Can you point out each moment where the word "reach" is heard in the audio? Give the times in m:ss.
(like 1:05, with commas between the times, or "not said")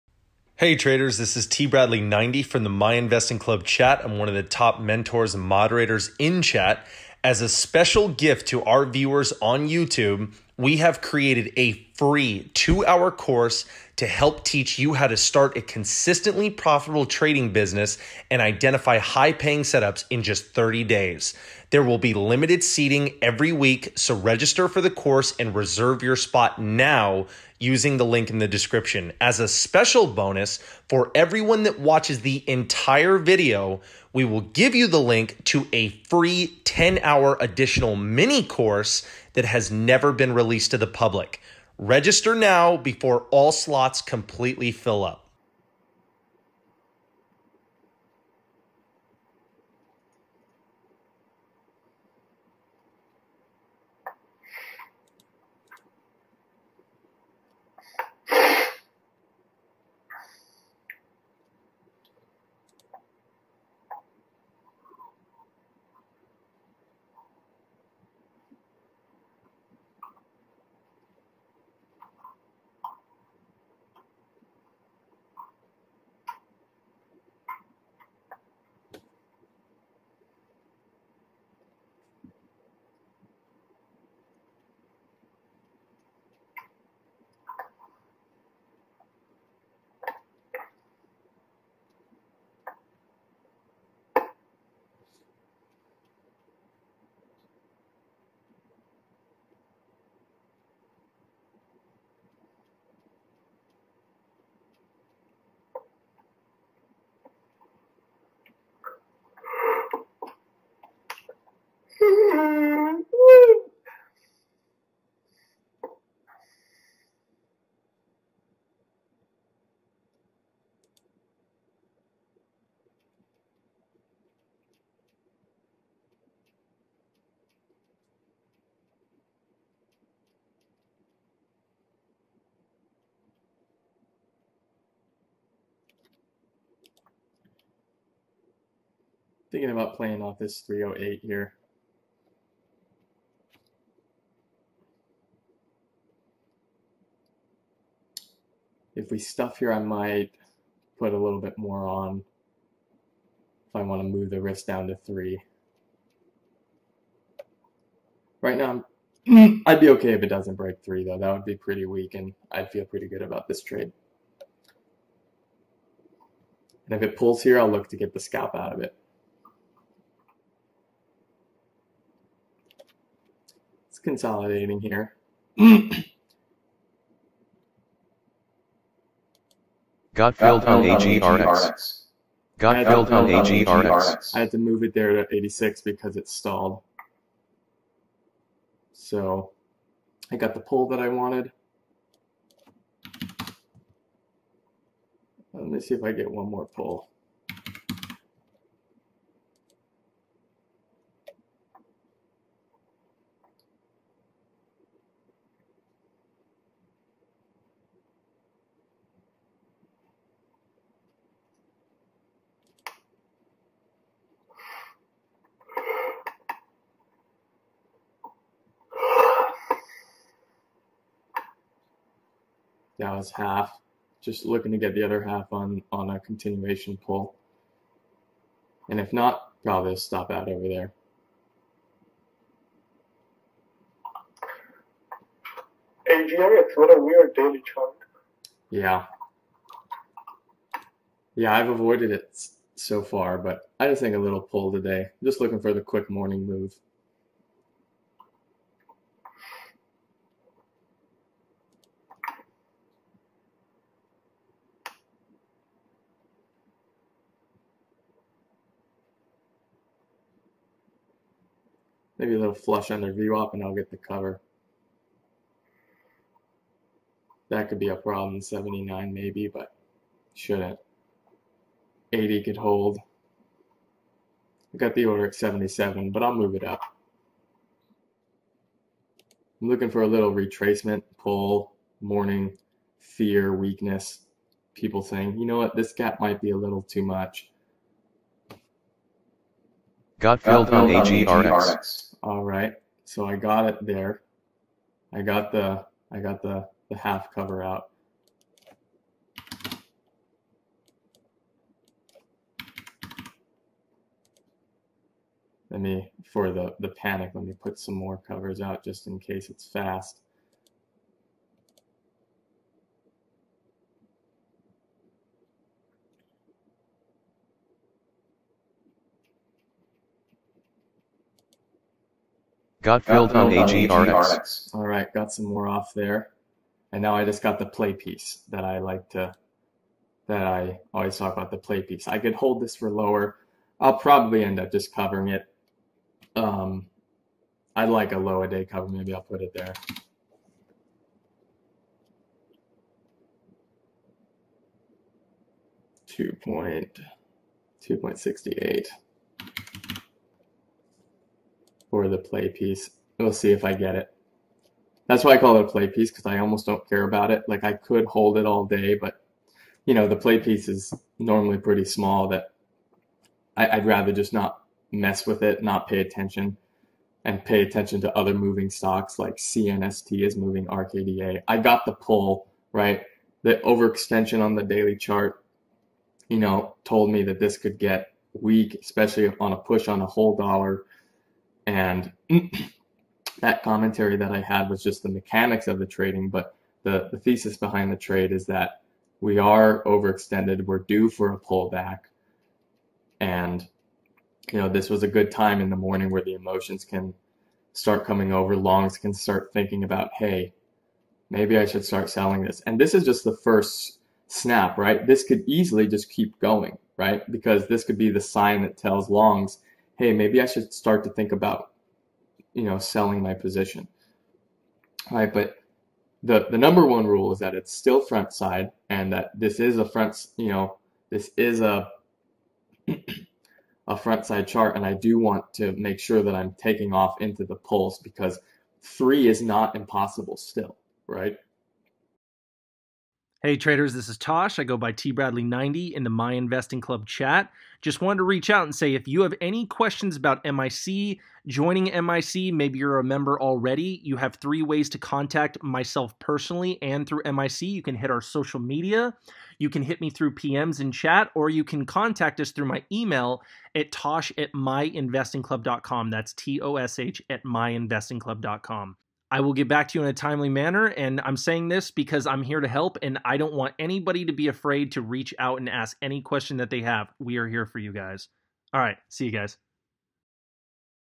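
7:18, 7:45.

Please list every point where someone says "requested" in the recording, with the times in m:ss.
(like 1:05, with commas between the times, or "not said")
not said.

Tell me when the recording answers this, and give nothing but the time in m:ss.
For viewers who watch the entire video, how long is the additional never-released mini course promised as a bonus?
0:36.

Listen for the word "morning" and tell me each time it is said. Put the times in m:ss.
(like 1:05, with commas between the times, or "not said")
4:06, 4:42, 6:35.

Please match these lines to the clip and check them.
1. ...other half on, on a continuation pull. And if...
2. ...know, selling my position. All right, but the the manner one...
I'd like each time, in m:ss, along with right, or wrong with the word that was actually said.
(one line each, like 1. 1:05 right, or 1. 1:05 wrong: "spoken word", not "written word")
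1. 3:45 right
2. 6:52 wrong: "number", not "manner".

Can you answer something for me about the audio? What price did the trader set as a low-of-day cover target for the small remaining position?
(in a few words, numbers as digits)
2.68.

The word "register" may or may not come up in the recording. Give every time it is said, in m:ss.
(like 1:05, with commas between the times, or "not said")
0:24, 0:41.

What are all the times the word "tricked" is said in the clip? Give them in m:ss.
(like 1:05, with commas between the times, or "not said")
not said.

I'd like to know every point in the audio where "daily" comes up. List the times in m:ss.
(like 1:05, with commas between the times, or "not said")
3:57, 6:14.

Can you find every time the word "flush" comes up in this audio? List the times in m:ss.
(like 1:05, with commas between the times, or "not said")
4:22.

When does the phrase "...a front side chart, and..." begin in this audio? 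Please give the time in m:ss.
7:03.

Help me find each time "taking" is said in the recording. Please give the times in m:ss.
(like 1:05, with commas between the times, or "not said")
7:06.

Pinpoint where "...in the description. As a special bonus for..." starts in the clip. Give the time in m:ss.
0:28.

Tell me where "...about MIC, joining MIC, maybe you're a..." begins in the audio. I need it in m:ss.
7:20.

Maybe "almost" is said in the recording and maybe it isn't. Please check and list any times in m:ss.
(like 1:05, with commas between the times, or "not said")
5:56.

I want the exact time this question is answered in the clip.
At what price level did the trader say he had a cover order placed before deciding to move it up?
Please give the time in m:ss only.
4:35.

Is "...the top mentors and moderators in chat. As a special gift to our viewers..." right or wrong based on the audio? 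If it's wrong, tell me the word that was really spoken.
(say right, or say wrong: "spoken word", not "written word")
right.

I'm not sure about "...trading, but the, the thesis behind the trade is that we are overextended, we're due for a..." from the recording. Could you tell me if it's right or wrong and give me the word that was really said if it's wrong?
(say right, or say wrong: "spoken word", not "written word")
right.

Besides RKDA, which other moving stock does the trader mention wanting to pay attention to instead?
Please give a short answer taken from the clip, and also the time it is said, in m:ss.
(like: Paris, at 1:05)
CNST, at 6:09.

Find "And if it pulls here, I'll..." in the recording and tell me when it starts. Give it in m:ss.
2:46.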